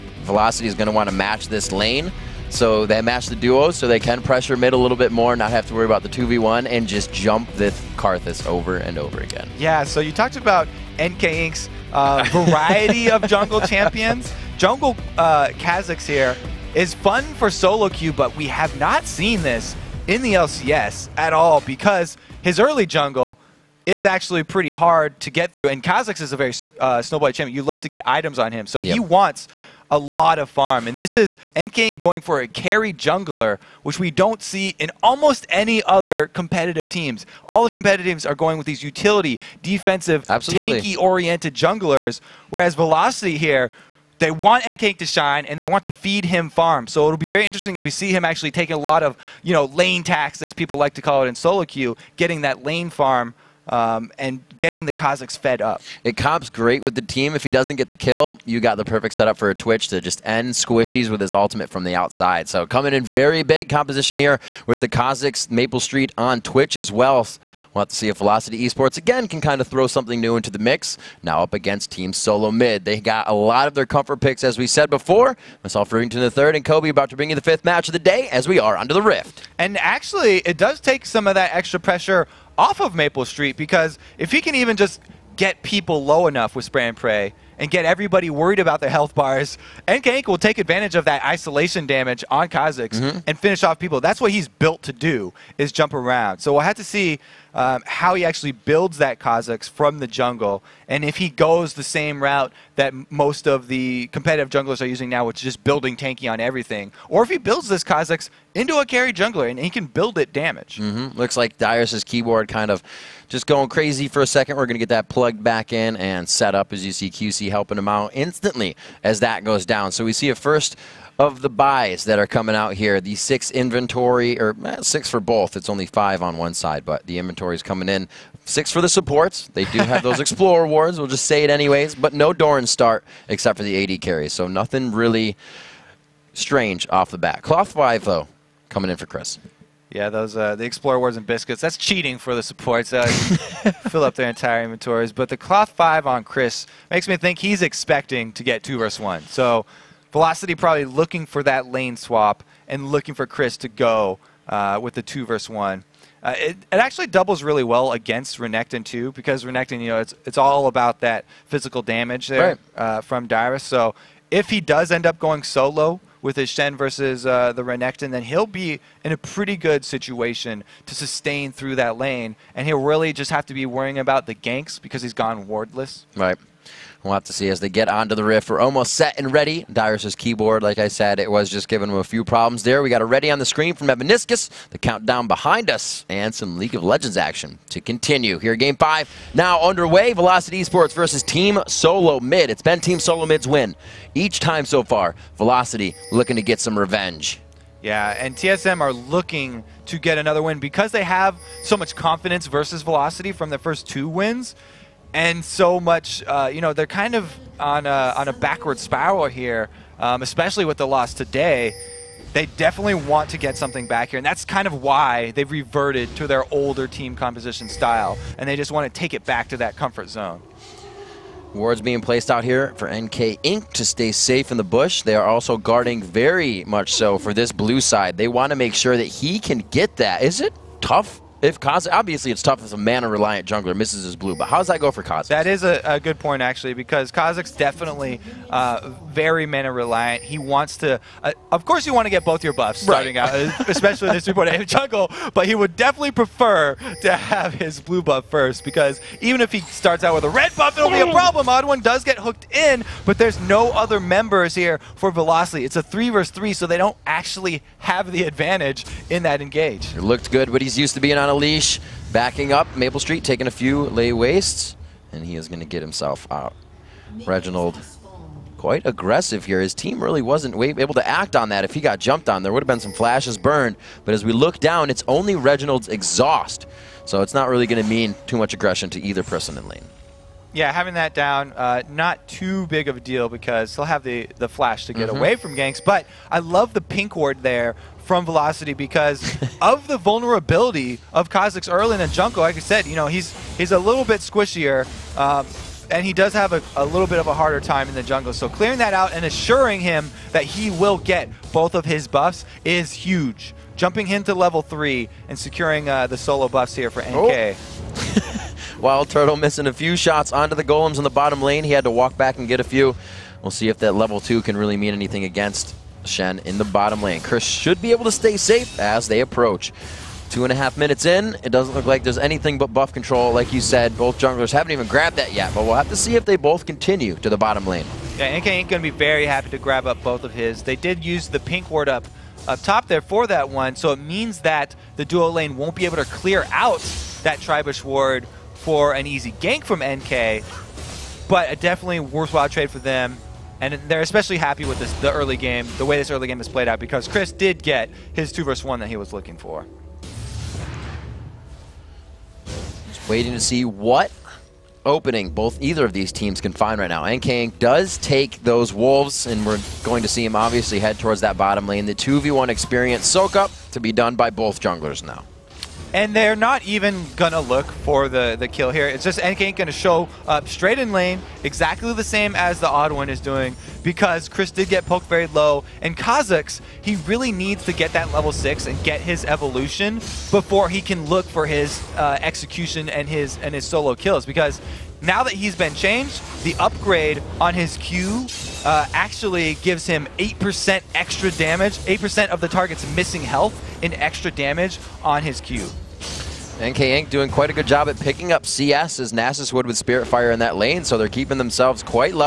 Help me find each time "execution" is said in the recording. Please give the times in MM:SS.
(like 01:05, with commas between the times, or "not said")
06:22.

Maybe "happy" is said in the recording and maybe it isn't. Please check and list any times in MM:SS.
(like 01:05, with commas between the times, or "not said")
05:29, 05:44.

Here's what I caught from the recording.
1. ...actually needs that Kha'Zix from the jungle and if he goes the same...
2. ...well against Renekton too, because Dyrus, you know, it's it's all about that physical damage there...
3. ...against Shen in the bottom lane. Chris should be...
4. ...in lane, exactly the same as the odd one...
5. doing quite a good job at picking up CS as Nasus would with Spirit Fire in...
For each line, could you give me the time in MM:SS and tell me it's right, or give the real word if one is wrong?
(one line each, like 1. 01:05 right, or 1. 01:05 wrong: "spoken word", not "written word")
1. 01:38 wrong: "builds", not "needs"
2. 02:37 wrong: "Renekton", not "Dyrus"
3. 05:15 right
4. 06:10 right
5. 06:37 right.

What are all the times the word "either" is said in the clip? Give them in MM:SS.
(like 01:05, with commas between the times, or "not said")
04:39, 05:55.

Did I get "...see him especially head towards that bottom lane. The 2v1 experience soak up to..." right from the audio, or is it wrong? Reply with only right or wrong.
wrong.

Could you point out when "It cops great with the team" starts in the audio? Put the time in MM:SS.
00:56.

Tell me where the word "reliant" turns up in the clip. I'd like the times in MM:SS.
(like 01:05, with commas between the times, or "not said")
03:52, 03:59.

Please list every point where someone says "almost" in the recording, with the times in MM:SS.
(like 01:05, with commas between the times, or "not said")
00:35, 02:58.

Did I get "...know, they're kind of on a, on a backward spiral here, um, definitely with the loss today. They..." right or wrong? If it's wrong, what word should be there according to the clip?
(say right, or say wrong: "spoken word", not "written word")
wrong: "especially", not "definitely".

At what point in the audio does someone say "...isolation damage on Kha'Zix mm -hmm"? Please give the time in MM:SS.
01:31.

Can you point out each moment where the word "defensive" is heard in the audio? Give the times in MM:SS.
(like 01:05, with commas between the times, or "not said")
00:39.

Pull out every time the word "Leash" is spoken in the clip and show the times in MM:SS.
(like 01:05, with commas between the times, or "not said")
04:21.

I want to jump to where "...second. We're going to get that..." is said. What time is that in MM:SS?
01:54.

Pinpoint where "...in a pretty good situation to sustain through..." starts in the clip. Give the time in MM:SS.
02:49.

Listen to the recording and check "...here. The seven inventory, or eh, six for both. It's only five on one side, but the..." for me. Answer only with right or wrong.
wrong.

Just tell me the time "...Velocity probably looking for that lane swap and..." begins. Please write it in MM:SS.
02:30.